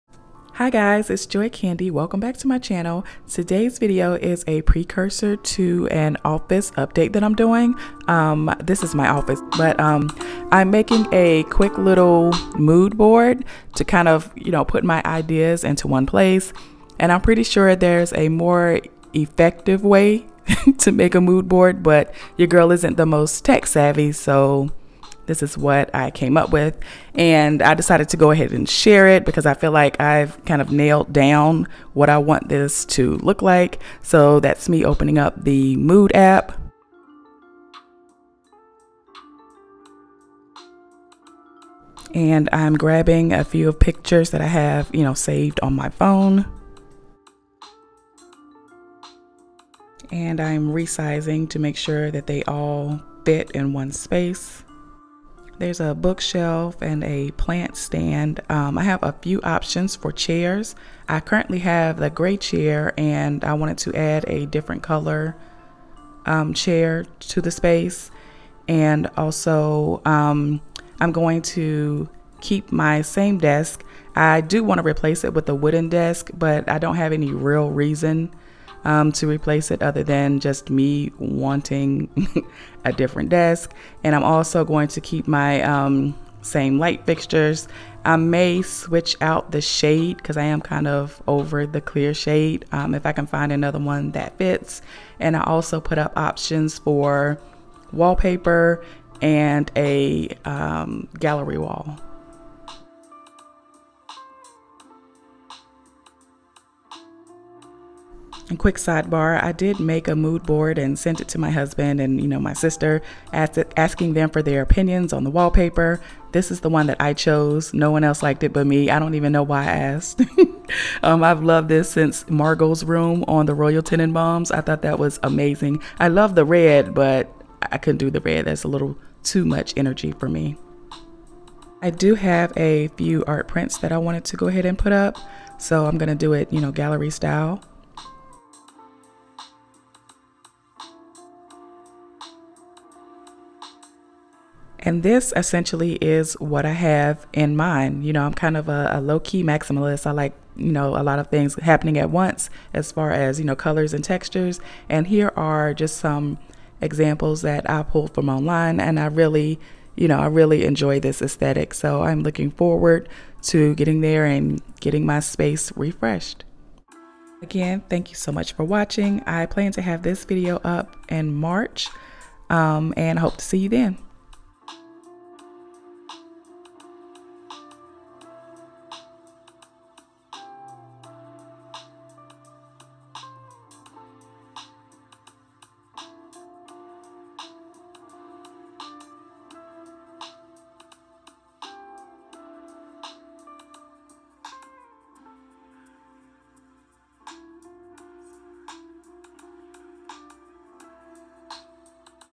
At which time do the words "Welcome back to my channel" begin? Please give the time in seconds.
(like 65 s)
1 s.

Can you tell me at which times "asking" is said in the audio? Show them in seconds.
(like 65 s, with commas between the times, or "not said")
113 s.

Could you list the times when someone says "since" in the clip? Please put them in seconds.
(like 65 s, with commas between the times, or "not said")
121 s.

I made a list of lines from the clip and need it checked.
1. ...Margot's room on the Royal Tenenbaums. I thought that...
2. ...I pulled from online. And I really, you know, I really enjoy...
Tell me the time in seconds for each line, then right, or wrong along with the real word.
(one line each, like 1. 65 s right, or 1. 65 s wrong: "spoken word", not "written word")
1. 122 s right
2. 157 s right.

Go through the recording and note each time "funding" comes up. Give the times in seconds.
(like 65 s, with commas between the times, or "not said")
not said.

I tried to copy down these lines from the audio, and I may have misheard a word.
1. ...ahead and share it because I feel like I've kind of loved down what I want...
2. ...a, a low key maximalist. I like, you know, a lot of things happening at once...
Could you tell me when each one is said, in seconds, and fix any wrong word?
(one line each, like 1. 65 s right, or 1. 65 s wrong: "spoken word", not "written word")
1. 28 s wrong: "nailed", not "loved"
2. 148 s right.